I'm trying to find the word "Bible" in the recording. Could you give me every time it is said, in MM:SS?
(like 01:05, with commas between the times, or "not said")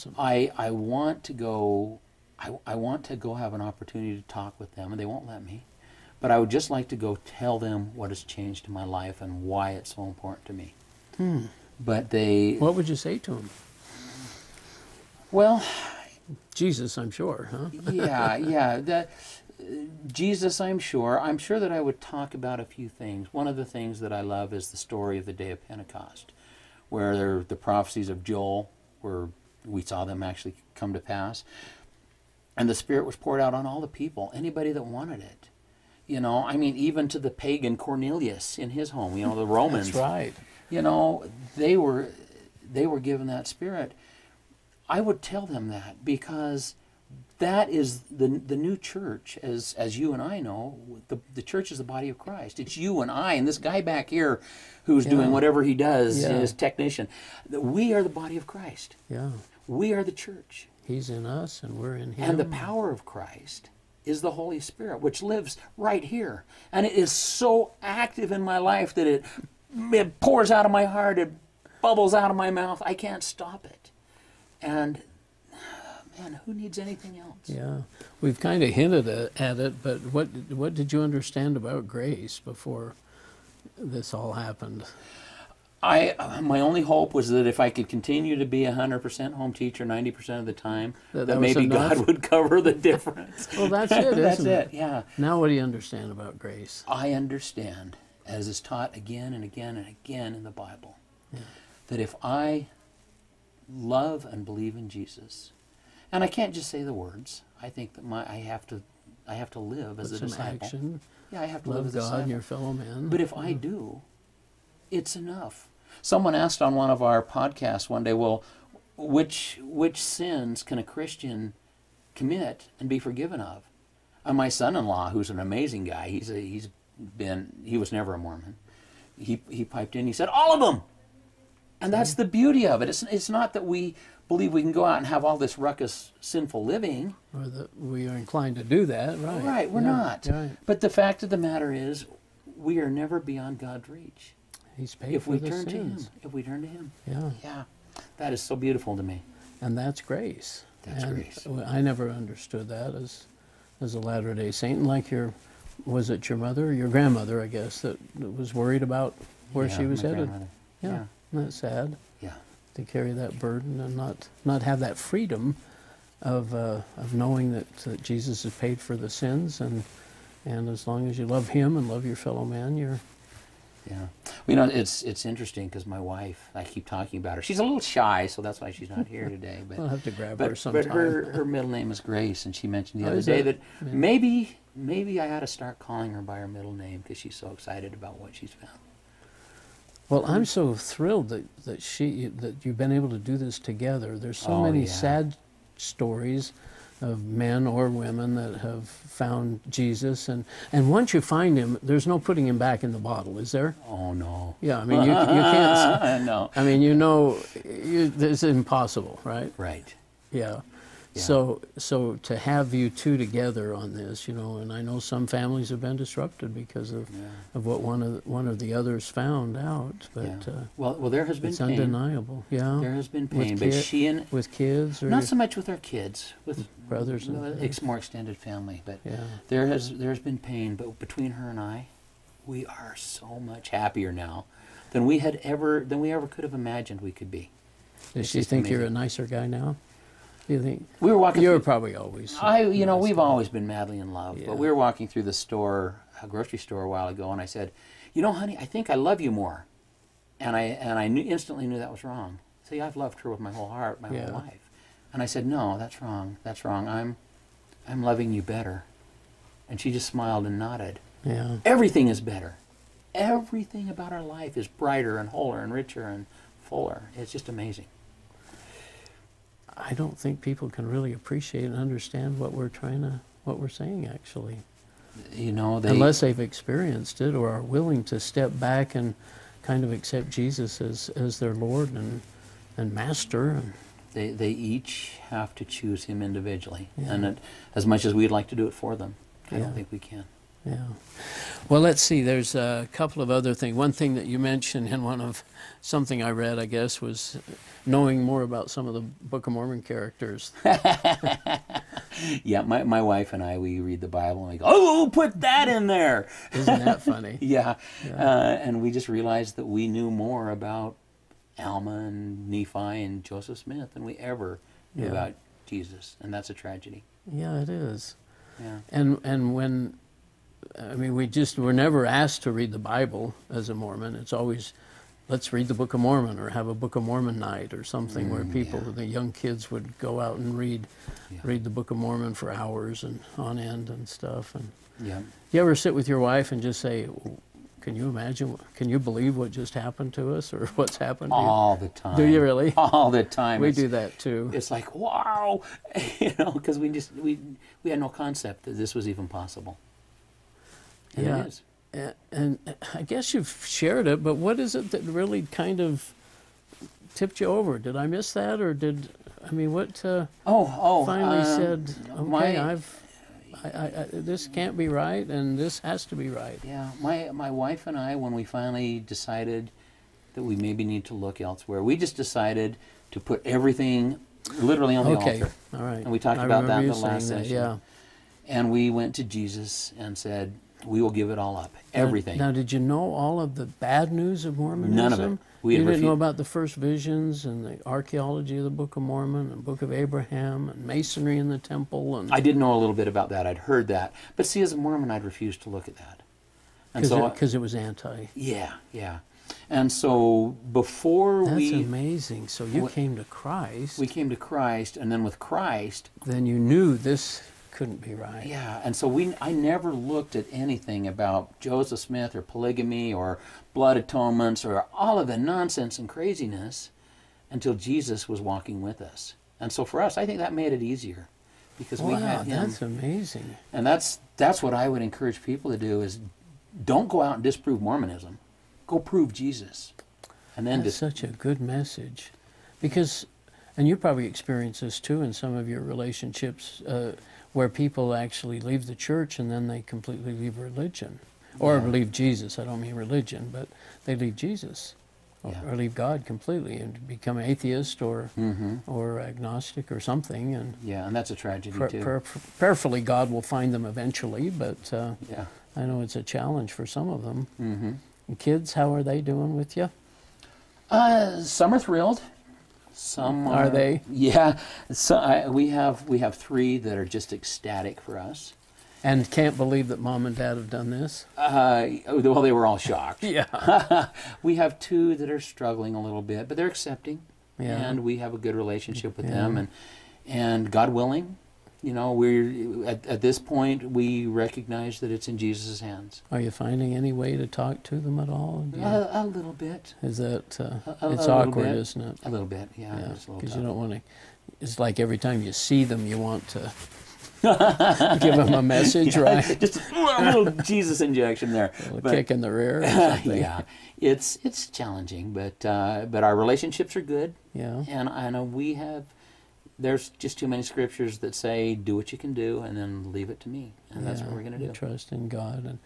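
01:40, 05:04, 05:22.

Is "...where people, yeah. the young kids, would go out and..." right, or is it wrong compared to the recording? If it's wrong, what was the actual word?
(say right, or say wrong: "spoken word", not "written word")
right.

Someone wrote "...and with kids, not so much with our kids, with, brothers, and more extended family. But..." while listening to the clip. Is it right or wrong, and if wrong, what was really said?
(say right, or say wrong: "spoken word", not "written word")
right.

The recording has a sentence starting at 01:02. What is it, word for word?
And the power of Christ is the Holy Spirit, which lives right here.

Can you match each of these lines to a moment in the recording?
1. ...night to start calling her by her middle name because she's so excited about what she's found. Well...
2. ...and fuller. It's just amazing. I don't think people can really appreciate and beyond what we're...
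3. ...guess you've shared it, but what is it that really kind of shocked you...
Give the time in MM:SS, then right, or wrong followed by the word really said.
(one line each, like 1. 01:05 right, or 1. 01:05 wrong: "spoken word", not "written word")
1. 03:05 wrong: "ought", not "night"
2. 04:26 wrong: "understand", not "beyond"
3. 05:53 wrong: "tipped", not "shocked".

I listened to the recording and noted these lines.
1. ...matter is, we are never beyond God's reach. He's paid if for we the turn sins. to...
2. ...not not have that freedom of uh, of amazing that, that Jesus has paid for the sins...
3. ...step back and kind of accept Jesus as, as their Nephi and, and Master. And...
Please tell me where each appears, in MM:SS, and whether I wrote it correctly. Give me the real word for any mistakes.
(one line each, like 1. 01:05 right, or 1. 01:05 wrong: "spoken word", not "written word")
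1. 02:21 right
2. 02:43 wrong: "knowing", not "amazing"
3. 04:38 wrong: "Lord", not "Nephi".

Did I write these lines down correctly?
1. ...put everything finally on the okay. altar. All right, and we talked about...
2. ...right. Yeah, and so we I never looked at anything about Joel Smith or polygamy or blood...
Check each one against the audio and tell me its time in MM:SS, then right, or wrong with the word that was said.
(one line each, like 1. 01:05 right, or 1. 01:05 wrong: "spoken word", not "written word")
1. 06:13 wrong: "literally", not "finally"
2. 06:48 wrong: "Joseph", not "Joel".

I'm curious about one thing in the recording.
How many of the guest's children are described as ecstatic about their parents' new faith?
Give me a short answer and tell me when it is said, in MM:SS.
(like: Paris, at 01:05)
3, at 07:46.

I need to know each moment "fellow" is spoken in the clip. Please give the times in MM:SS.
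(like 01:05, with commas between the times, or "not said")
01:52, 02:52.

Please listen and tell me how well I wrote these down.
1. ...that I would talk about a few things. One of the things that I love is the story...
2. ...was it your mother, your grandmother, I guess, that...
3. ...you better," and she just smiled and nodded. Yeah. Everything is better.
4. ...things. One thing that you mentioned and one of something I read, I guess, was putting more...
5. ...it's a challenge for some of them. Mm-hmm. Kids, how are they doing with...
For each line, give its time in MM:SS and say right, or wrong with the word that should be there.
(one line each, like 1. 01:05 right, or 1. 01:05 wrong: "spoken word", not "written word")
1. 00:21 right
2. 02:35 right
3. 04:18 right
4. 04:53 wrong: "knowing", not "putting"
5. 07:36 right.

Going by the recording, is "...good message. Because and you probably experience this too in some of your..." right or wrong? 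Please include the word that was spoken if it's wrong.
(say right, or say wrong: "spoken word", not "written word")
right.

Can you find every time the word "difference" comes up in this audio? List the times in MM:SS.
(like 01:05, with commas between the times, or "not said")
01:32.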